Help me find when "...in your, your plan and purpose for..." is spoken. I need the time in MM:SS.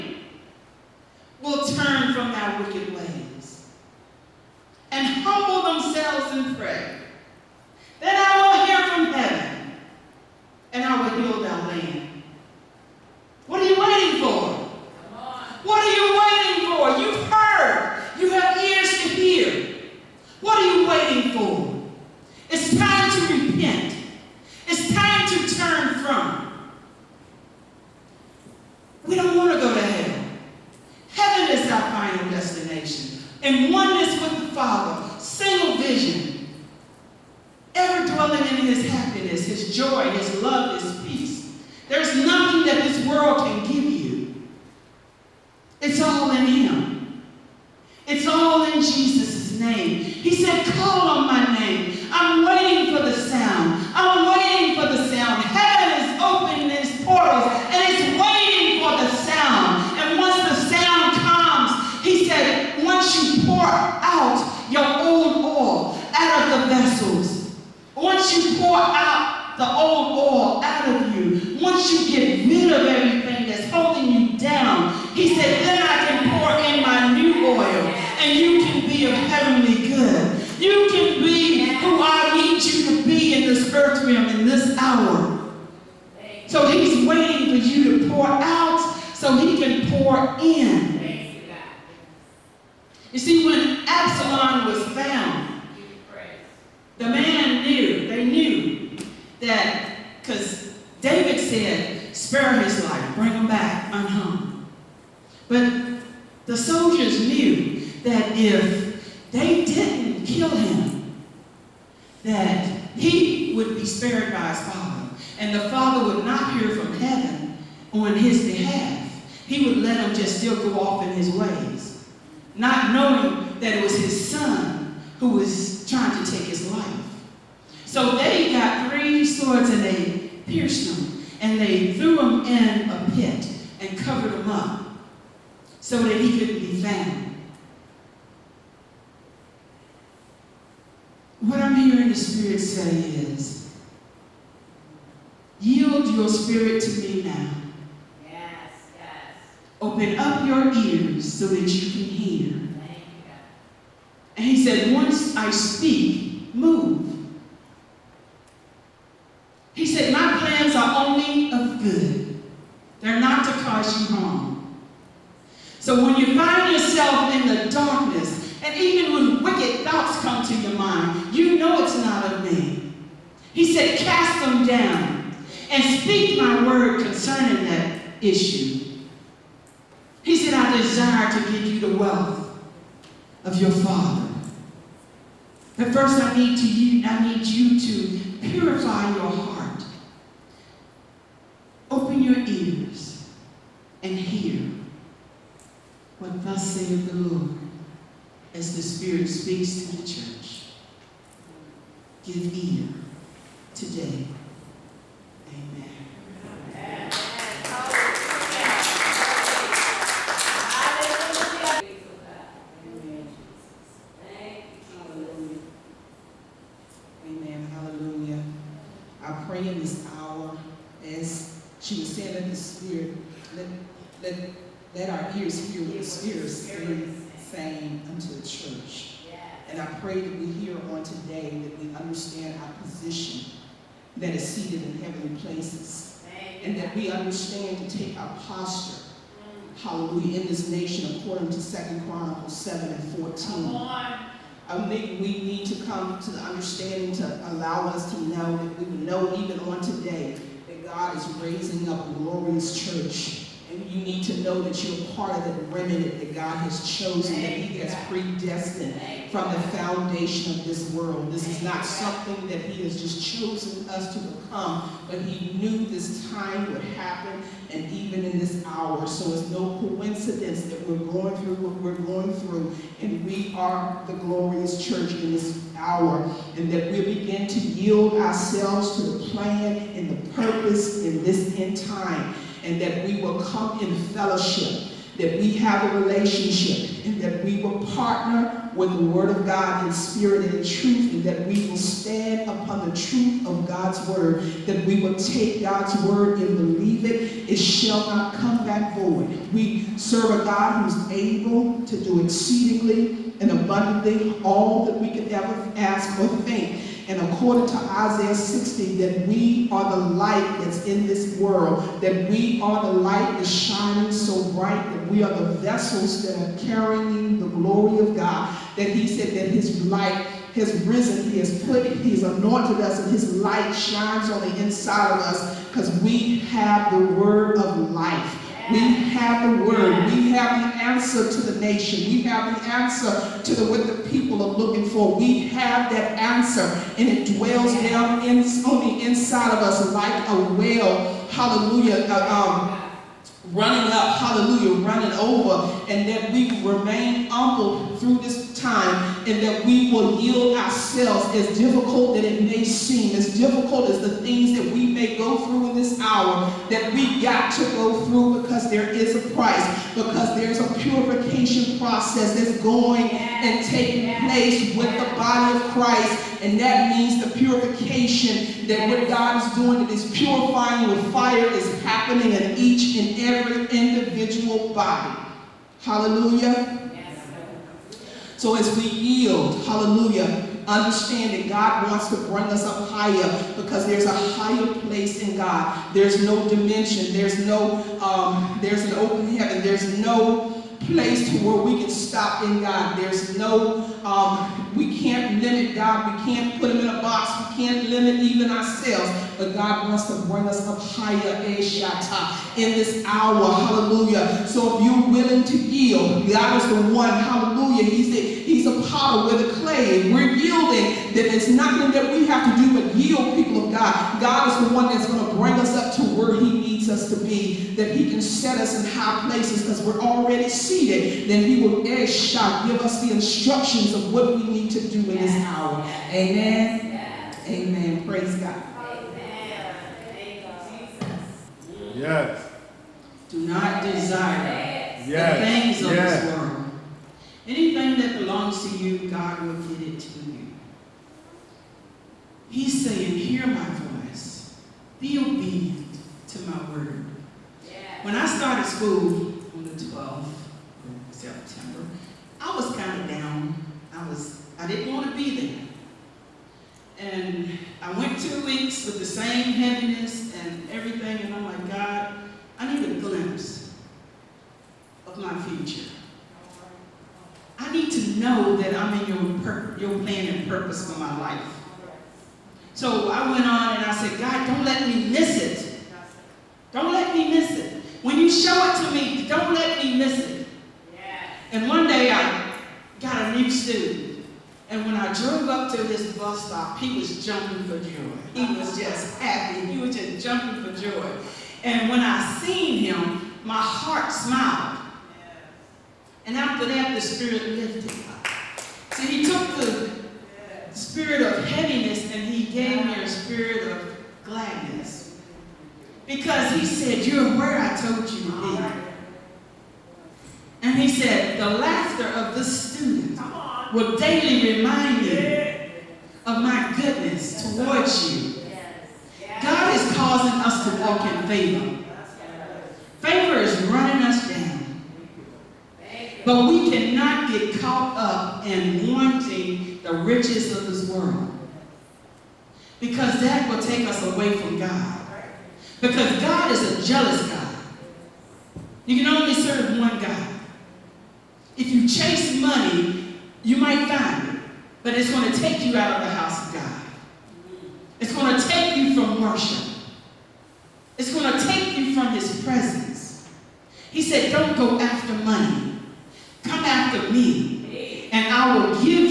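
07:49.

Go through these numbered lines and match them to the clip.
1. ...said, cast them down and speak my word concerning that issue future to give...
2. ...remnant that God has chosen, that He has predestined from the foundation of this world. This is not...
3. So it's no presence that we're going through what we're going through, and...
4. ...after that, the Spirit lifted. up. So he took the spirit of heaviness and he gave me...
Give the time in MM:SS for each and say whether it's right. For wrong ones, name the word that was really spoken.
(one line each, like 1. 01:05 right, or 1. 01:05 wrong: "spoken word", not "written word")
1. 02:53 wrong: "desire", not "future"
2. 04:15 right
3. 04:29 wrong: "coincidence", not "presence"
4. 08:16 right.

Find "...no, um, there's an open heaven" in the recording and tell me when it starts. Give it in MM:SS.
06:27.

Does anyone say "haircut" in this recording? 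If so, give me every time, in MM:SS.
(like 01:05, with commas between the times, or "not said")
not said.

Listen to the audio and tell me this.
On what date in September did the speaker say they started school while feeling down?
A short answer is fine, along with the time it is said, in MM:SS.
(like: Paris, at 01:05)
September 12, at 07:29.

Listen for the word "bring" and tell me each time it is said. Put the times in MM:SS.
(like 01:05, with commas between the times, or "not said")
01:43, 06:22, 06:40, 06:55.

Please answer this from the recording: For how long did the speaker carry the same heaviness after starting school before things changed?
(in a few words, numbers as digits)
2 weeks.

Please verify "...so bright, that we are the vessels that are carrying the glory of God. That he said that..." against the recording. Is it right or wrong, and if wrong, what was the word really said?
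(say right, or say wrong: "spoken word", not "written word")
right.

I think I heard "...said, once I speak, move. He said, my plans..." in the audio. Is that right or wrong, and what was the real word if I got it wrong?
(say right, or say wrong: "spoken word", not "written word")
right.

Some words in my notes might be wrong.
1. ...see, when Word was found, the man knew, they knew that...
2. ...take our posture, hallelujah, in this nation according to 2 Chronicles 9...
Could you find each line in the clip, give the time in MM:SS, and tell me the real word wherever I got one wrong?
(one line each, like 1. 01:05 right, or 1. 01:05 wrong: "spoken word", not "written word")
1. 01:33 wrong: "Absalom", not "Word"
2. 03:57 wrong: "7", not "9".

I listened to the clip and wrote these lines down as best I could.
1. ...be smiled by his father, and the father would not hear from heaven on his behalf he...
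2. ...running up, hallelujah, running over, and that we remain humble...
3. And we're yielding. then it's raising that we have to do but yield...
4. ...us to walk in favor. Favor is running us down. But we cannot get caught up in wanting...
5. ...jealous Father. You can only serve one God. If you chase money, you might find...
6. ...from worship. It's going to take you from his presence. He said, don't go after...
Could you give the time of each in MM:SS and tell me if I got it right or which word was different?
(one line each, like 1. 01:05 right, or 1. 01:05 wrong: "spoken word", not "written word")
1. 01:53 wrong: "spared", not "smiled"
2. 05:43 right
3. 06:50 wrong: "nothing", not "raising"
4. 08:40 right
5. 08:56 wrong: "God", not "Father"
6. 09:08 right.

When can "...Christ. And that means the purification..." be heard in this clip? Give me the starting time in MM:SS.
06:05.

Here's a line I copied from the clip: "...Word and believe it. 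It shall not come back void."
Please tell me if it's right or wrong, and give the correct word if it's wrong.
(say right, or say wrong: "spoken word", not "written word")
right.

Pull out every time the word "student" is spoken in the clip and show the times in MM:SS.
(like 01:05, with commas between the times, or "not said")
08:03, 08:32.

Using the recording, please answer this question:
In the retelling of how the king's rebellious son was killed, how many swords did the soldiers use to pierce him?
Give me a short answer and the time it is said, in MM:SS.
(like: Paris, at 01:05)
3, at 02:08.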